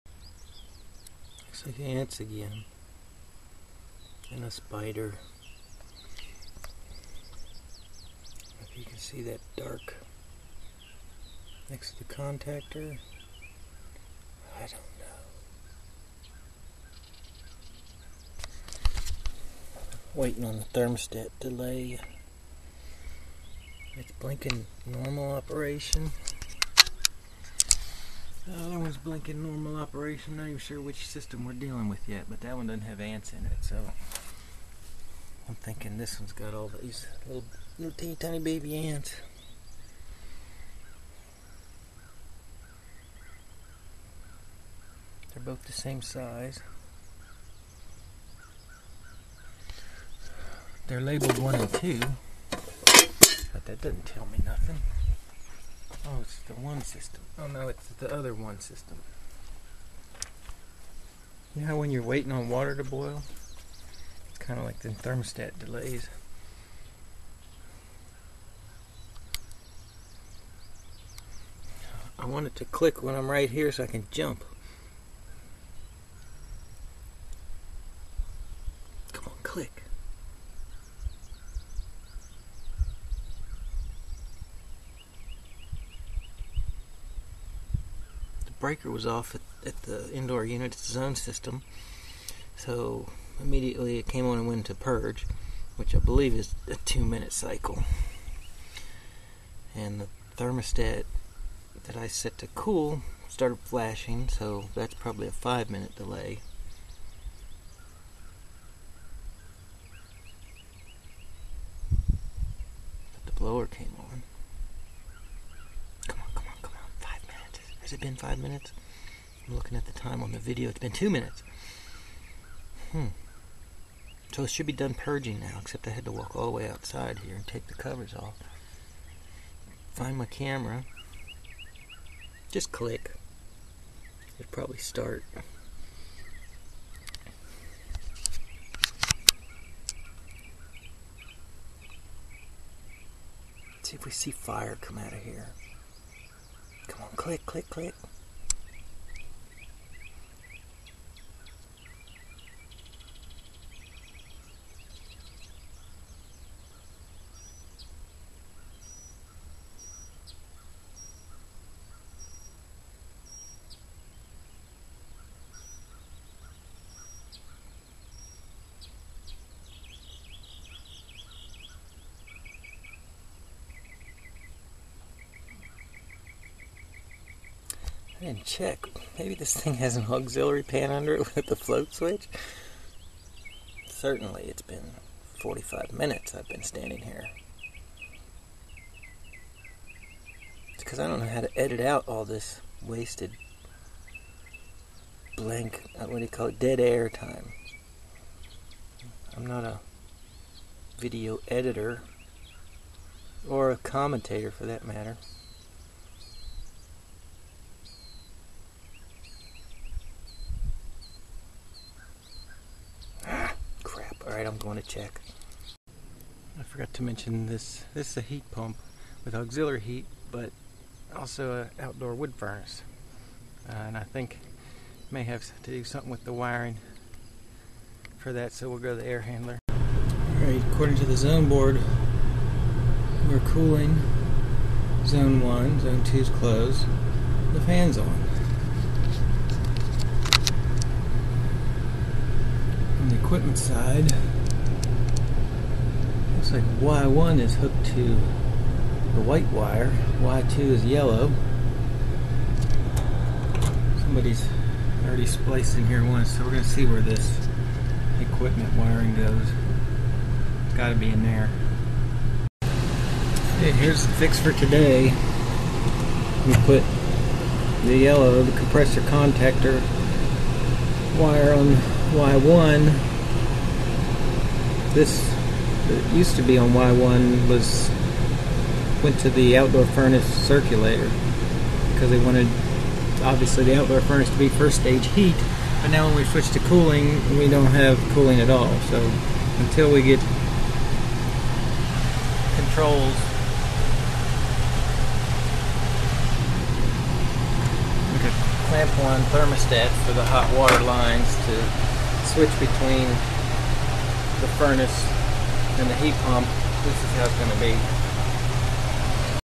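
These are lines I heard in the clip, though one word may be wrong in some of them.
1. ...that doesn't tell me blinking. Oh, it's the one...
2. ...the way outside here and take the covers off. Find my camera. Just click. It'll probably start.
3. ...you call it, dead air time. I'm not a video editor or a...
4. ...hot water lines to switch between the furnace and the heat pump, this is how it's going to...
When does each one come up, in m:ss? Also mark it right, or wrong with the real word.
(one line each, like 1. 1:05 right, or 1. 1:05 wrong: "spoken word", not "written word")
1. 0:53 wrong: "nothing", not "blinking"
2. 2:06 right
3. 3:16 right
4. 5:00 right.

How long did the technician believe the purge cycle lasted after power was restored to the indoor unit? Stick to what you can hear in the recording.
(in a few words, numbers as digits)
2 minutes.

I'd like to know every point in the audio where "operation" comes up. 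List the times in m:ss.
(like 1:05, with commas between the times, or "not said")
0:25, 0:29.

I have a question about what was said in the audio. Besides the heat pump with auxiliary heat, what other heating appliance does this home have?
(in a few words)
Outdoor wood furnace.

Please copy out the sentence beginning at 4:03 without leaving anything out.
equipment side, looks like Y1 is hooked to the white wire, Y2 is yellow.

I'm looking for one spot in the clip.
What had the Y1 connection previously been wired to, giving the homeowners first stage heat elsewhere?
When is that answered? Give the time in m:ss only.
4:39.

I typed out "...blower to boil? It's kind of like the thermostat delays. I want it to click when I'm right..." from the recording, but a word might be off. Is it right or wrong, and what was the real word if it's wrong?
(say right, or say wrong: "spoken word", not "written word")
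wrong: "water", not "blower".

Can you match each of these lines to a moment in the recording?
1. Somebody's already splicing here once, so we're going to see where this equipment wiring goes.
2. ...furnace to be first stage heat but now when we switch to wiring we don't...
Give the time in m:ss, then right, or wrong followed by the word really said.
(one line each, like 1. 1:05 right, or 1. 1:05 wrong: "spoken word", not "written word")
1. 4:14 right
2. 4:44 wrong: "cooling", not "wiring".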